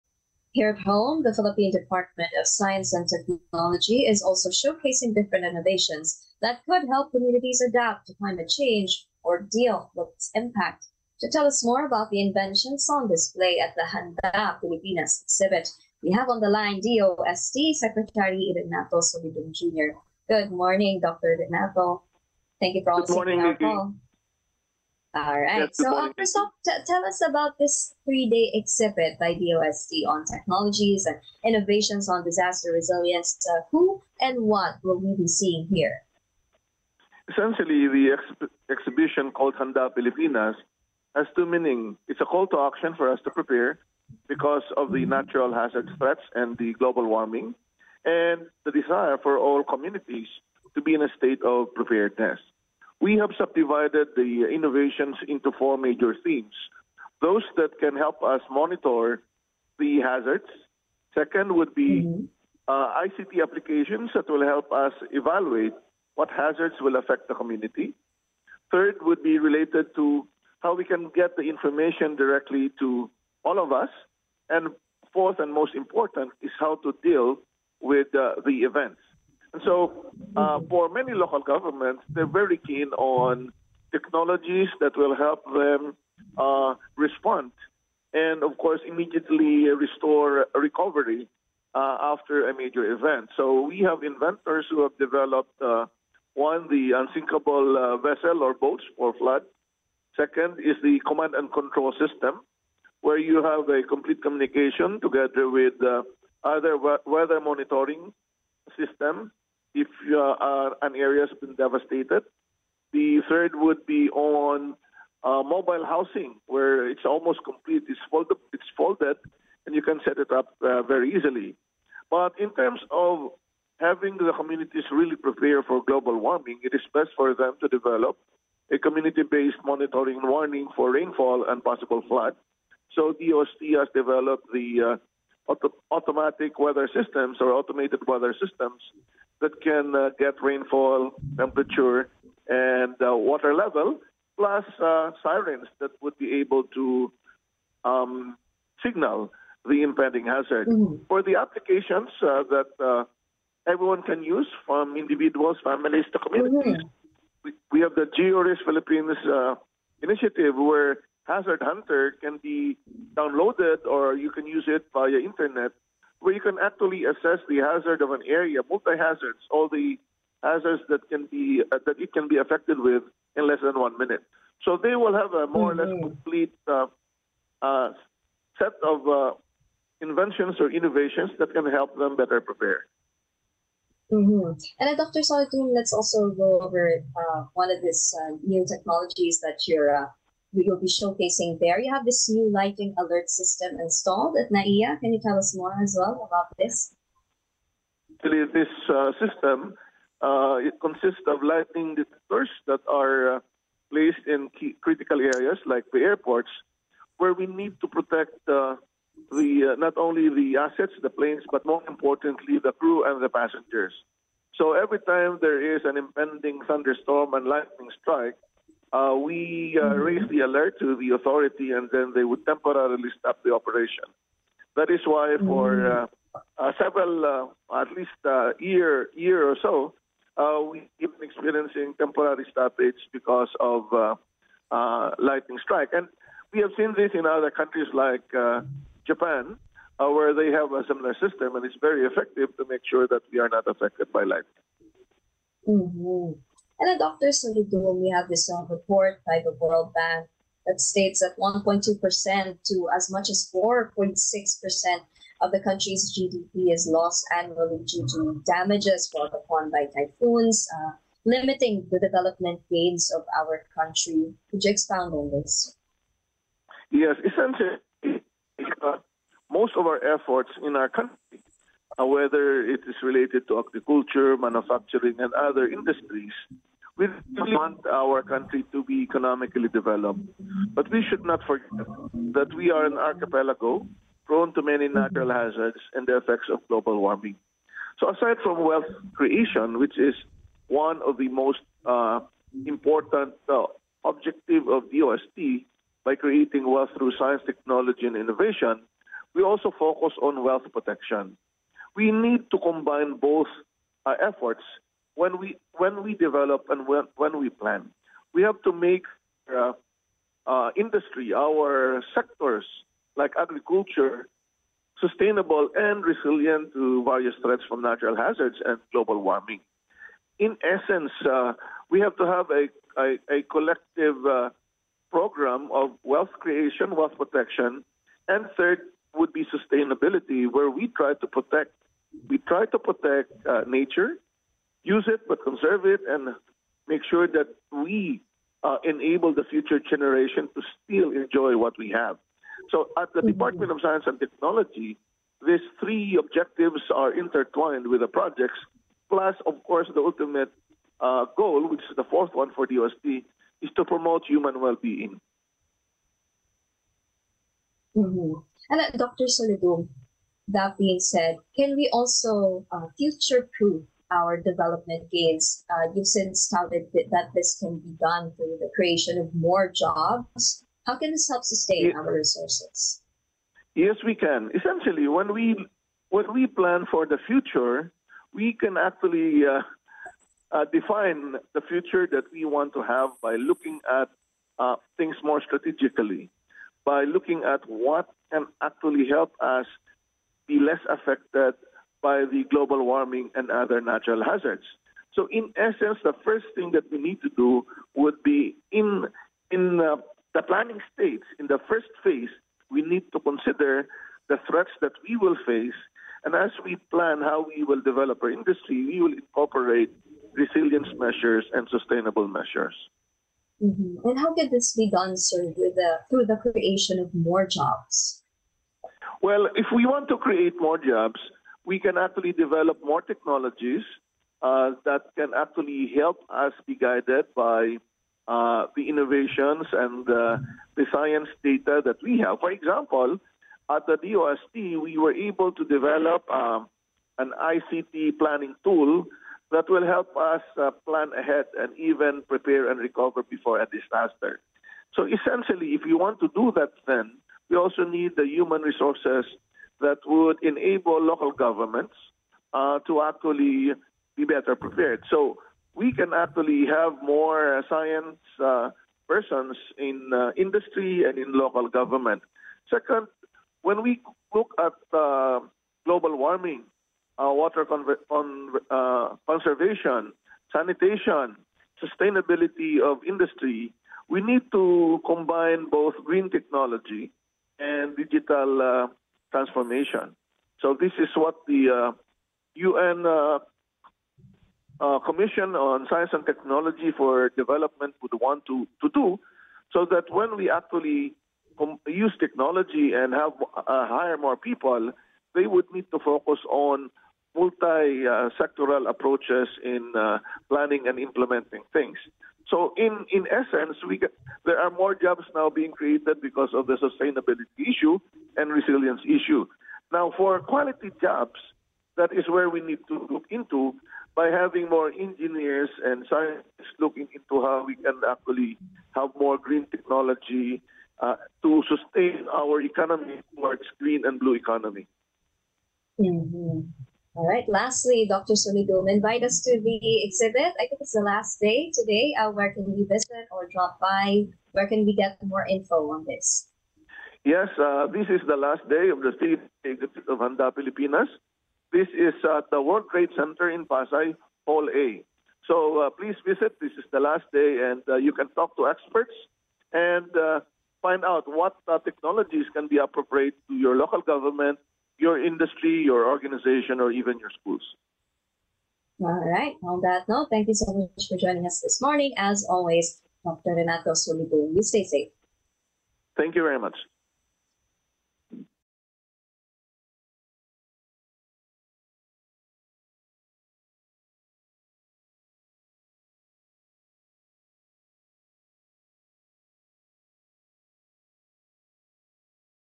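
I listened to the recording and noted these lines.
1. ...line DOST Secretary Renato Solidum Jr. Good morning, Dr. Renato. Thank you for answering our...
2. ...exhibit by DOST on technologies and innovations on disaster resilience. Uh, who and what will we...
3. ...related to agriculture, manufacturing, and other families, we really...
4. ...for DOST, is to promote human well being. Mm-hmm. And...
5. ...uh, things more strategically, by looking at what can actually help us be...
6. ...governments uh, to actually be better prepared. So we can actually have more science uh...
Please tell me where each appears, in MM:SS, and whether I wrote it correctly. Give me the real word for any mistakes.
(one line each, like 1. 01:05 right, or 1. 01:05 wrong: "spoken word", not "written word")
1. 00:16 right
2. 00:28 right
3. 04:33 wrong: "industries", not "families"
4. 05:52 right
5. 06:24 right
6. 07:31 right.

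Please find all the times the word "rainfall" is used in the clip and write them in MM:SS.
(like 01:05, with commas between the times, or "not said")
02:10, 02:20.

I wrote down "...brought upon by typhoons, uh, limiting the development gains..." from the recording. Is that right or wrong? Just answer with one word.
right.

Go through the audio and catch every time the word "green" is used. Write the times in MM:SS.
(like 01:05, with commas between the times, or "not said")
07:56, 08:39, 08:43.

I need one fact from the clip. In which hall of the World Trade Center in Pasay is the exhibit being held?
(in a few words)
Hall A.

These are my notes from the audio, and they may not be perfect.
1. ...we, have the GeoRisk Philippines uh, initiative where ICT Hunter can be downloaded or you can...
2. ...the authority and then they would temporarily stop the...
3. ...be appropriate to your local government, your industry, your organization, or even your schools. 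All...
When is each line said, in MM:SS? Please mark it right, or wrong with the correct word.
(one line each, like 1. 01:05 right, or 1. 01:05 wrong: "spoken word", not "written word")
1. 02:37 wrong: "Hazard", not "ICT"
2. 03:40 right
3. 09:12 right.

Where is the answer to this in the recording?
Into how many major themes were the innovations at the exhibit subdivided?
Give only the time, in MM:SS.
00:55.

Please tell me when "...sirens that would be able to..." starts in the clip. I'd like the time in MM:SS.
02:25.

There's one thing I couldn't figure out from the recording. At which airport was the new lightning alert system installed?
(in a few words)
NAIA.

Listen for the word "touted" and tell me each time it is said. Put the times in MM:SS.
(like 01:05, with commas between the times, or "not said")
06:06.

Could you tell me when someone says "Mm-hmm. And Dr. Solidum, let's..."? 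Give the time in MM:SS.
03:04.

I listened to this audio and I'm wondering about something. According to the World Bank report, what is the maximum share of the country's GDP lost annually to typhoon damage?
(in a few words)
4.6%.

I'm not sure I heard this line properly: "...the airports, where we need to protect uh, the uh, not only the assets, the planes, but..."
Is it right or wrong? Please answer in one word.
right.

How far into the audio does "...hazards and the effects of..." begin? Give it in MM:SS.
04:45.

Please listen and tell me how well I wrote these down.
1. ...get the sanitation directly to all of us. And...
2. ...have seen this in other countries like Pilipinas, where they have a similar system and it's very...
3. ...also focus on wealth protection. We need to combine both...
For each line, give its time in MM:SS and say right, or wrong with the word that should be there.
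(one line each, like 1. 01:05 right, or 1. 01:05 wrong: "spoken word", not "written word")
1. 01:11 wrong: "information", not "sanitation"
2. 03:56 wrong: "Japan", not "Pilipinas"
3. 04:59 right.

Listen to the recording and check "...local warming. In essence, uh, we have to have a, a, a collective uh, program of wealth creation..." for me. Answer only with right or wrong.
wrong.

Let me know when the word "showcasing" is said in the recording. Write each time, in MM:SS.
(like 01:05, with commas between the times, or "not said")
00:04, 03:10.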